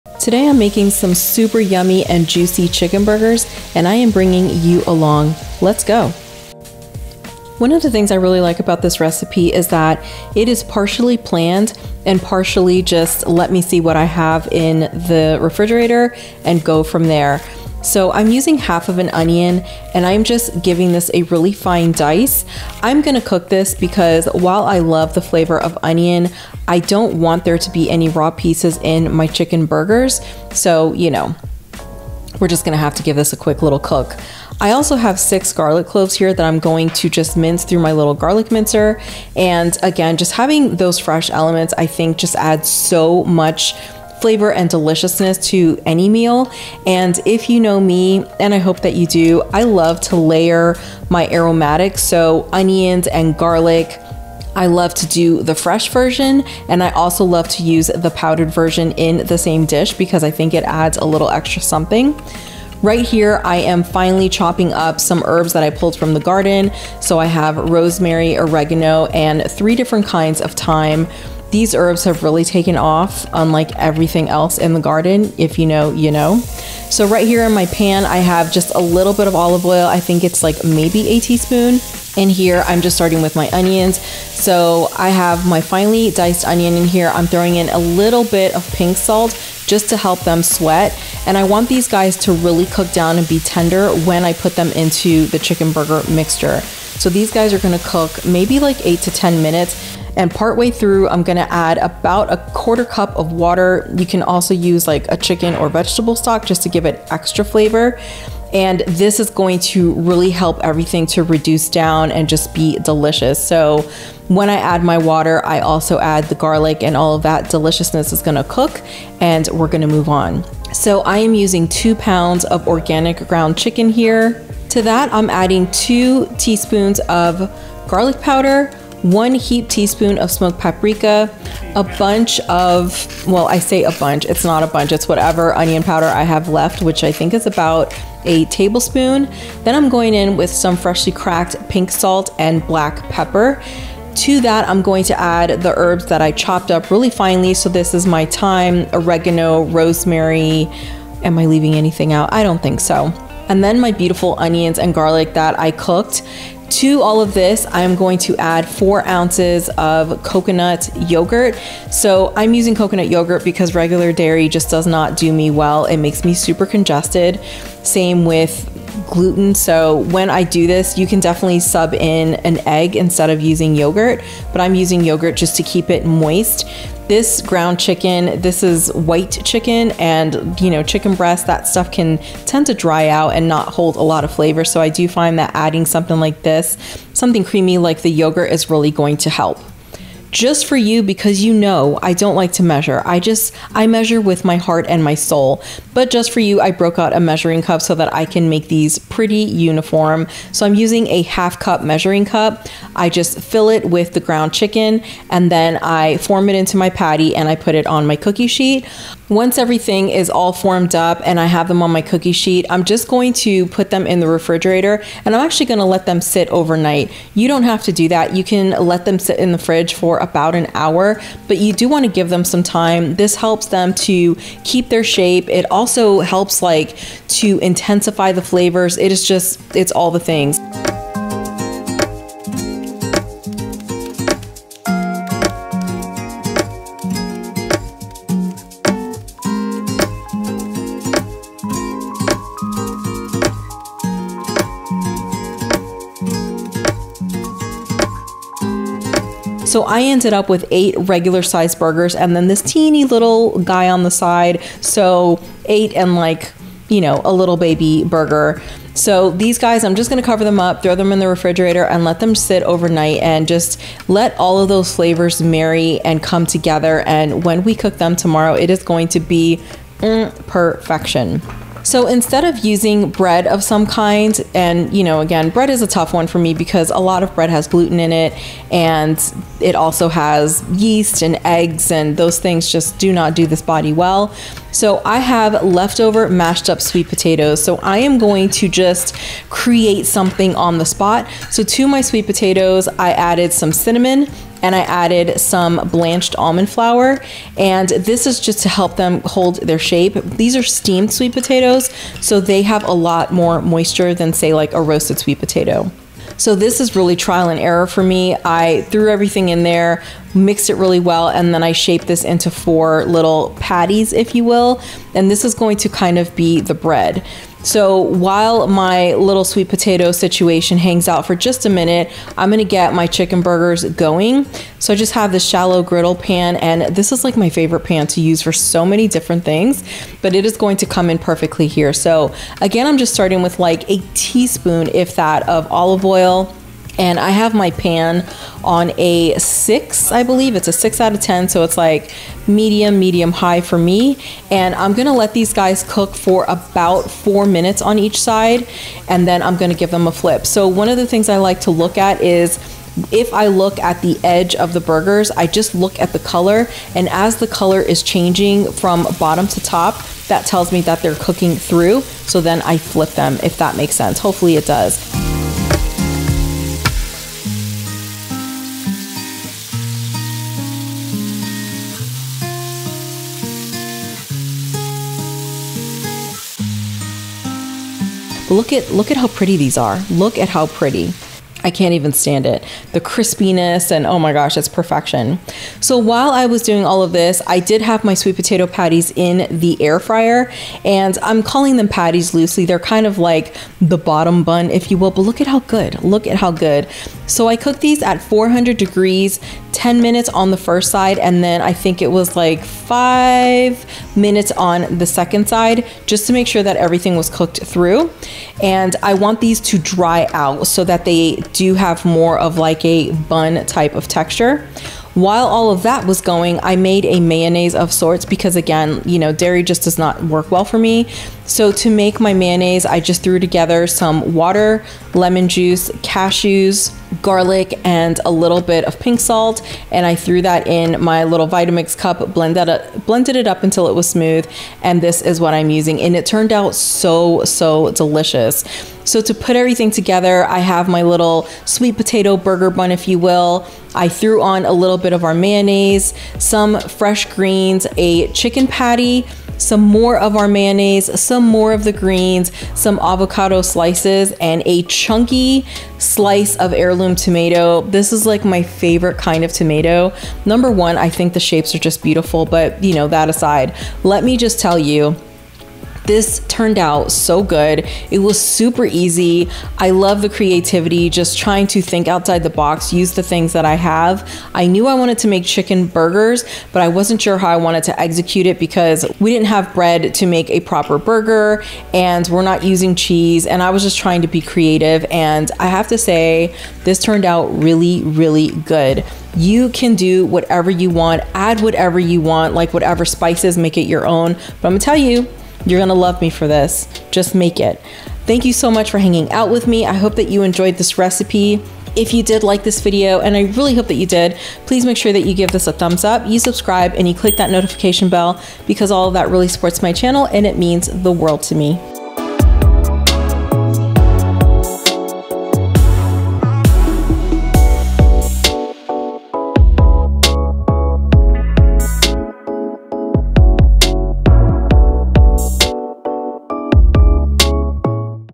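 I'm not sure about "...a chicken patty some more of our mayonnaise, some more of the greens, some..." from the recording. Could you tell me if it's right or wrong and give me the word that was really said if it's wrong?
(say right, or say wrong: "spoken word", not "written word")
right.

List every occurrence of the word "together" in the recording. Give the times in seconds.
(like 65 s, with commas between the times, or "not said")
266 s, 423 s, 439 s.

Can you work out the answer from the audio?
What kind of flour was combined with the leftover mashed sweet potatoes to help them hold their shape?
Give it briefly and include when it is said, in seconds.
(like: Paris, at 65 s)
blanched almond flour, at 295 s.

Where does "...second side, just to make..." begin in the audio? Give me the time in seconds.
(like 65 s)
405 s.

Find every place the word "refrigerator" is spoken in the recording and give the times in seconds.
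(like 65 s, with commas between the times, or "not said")
15 s, 214 s, 261 s.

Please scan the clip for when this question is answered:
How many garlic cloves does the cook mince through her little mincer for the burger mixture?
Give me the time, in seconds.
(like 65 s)
35 s.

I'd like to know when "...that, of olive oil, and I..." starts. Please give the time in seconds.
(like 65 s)
335 s.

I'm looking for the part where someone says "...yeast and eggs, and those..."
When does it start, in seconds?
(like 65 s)
280 s.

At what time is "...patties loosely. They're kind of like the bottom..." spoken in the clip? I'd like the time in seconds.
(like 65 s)
391 s.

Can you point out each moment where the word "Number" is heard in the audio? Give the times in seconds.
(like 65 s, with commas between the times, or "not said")
460 s.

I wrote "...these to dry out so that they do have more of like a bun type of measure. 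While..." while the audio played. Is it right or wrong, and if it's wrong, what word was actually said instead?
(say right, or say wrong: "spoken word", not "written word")
wrong: "texture", not "measure".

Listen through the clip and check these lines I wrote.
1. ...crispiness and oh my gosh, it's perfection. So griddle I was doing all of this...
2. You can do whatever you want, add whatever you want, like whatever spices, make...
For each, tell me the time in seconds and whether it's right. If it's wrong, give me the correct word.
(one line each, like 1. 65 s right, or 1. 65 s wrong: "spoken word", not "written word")
1. 382 s wrong: "while", not "griddle"
2. 489 s right.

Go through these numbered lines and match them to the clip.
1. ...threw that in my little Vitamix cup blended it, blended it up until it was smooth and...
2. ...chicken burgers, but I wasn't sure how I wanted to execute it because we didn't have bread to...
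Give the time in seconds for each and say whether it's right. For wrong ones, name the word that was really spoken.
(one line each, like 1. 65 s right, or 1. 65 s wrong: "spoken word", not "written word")
1. 430 s right
2. 475 s right.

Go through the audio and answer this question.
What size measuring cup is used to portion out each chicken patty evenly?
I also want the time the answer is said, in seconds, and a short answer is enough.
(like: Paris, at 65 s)
half cup, at 201 s.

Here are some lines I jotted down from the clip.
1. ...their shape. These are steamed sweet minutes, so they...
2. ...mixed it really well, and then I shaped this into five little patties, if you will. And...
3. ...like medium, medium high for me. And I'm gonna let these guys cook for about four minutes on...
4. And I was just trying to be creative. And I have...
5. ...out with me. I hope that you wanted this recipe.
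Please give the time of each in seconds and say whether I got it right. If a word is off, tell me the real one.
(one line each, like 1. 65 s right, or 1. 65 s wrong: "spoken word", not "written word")
1. 299 s wrong: "potatoes", not "minutes"
2. 310 s wrong: "four", not "five"
3. 341 s right
4. 483 s right
5. 499 s wrong: "enjoyed", not "wanted".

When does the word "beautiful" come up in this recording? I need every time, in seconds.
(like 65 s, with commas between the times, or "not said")
153 s, 462 s.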